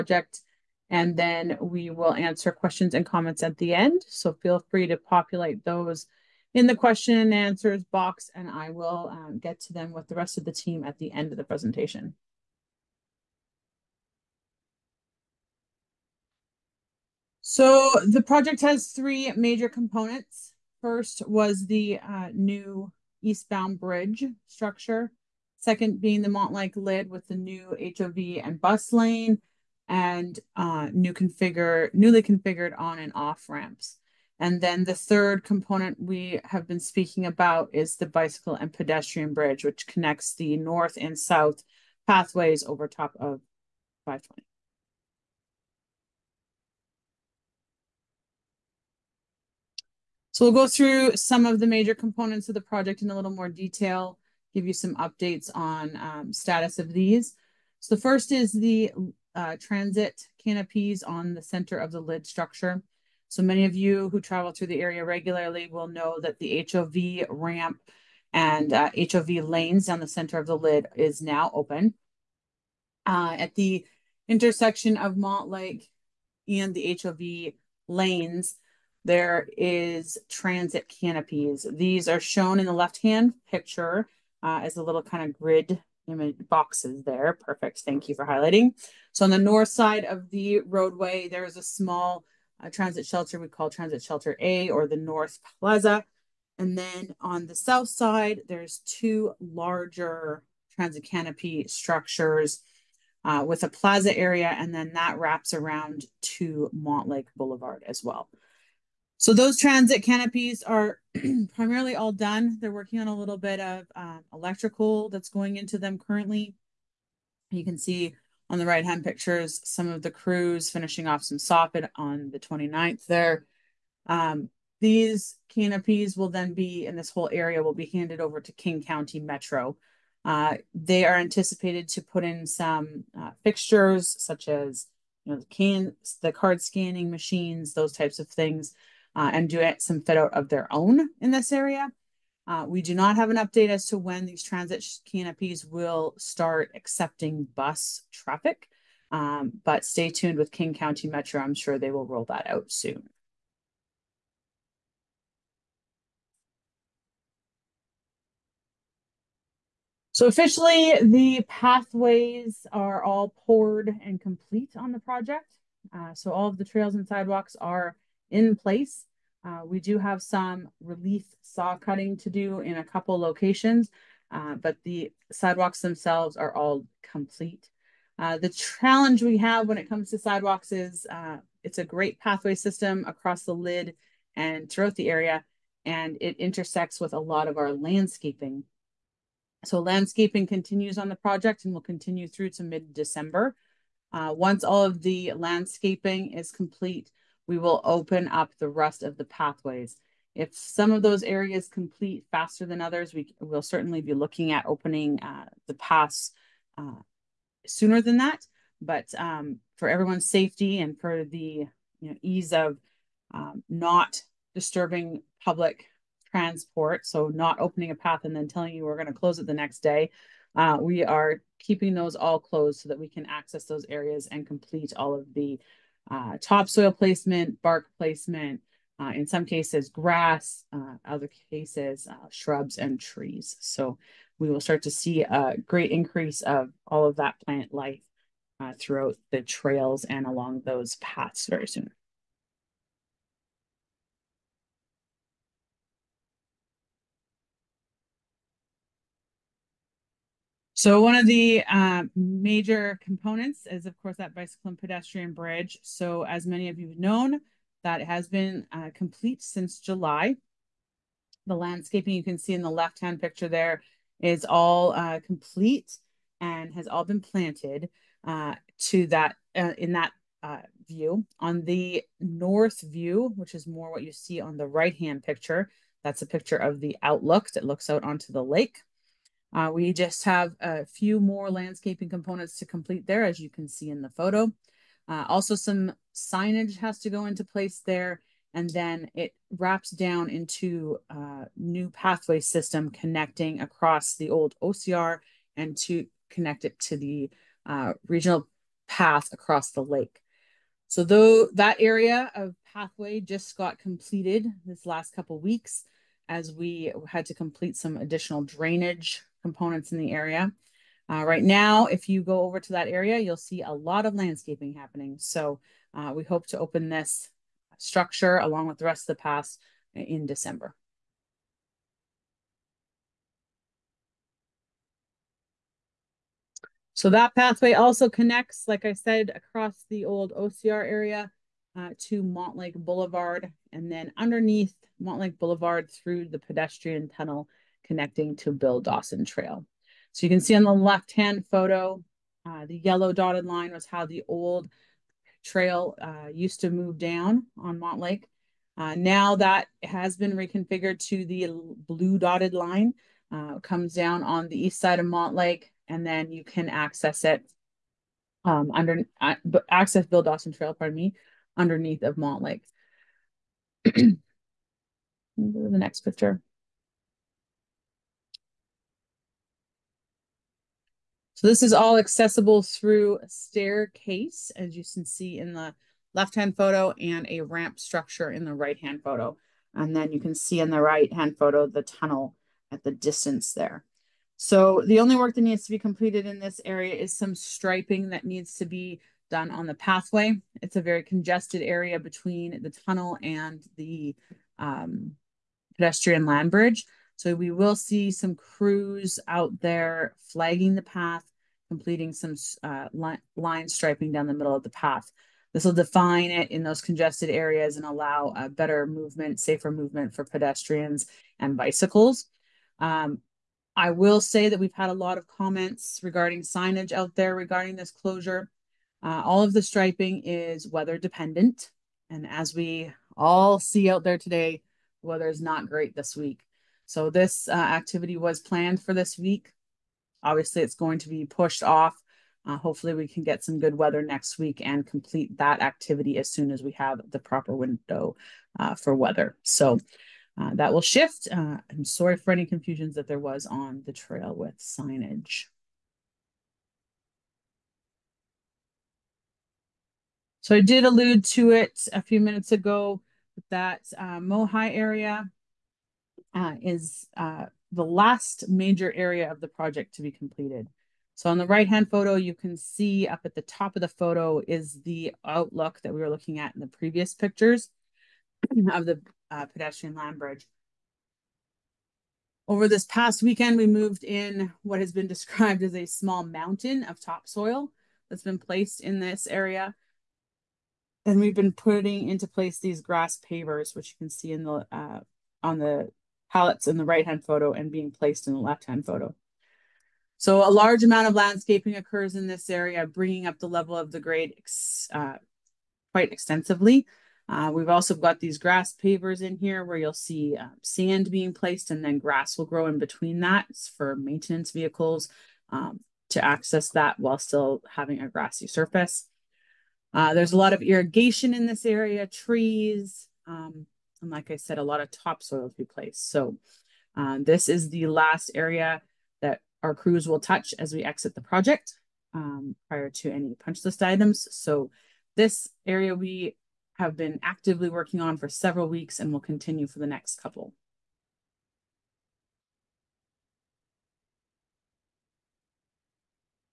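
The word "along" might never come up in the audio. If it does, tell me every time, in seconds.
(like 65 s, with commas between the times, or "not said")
240 s, 318 s.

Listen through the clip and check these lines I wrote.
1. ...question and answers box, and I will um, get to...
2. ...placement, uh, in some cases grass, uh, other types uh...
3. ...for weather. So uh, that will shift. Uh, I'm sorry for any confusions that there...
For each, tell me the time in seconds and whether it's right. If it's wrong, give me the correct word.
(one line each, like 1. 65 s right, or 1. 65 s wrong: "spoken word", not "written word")
1. 6 s right
2. 227 s wrong: "cases", not "types"
3. 438 s right.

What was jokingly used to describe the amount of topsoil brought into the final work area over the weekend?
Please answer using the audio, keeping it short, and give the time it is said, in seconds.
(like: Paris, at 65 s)
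small mountain, at 475 s.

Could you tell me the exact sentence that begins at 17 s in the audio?
So the project has three major components.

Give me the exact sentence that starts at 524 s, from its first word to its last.
So this area we have been actively working on for several weeks and will continue for the next couple.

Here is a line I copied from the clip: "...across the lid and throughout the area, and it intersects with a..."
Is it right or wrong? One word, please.
right.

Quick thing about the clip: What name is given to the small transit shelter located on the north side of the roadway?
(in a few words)
Transit Shelter A.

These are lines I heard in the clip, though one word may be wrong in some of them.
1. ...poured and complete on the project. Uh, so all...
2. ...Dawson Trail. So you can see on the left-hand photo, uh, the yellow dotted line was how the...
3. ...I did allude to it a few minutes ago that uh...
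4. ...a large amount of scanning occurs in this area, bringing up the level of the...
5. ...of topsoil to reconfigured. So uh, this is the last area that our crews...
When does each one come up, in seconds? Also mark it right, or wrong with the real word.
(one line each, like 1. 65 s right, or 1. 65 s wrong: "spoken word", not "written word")
1. 163 s right
2. 338 s right
3. 450 s right
4. 490 s wrong: "landscaping", not "scanning"
5. 514 s wrong: "placed", not "reconfigured".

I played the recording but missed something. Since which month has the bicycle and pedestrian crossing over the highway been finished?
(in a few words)
July.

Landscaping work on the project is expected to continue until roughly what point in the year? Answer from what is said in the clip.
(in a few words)
mid-December.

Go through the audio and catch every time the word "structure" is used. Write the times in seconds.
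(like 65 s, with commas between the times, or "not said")
24 s, 62 s, 101 s, 317 s, 377 s.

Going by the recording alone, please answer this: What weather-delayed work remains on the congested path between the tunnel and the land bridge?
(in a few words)
line striping.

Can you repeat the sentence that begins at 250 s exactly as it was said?
So one of the uh, major components is, of course, that bicycle and pedestrian bridge.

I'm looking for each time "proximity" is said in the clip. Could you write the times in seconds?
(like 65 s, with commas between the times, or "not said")
not said.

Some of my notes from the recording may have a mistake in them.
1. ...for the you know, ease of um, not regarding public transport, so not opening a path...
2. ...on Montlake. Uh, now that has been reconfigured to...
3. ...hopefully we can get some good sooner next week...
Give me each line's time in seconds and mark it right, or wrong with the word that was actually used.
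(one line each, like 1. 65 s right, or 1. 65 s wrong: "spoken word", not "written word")
1. 210 s wrong: "disturbing", not "regarding"
2. 347 s right
3. 432 s wrong: "weather", not "sooner".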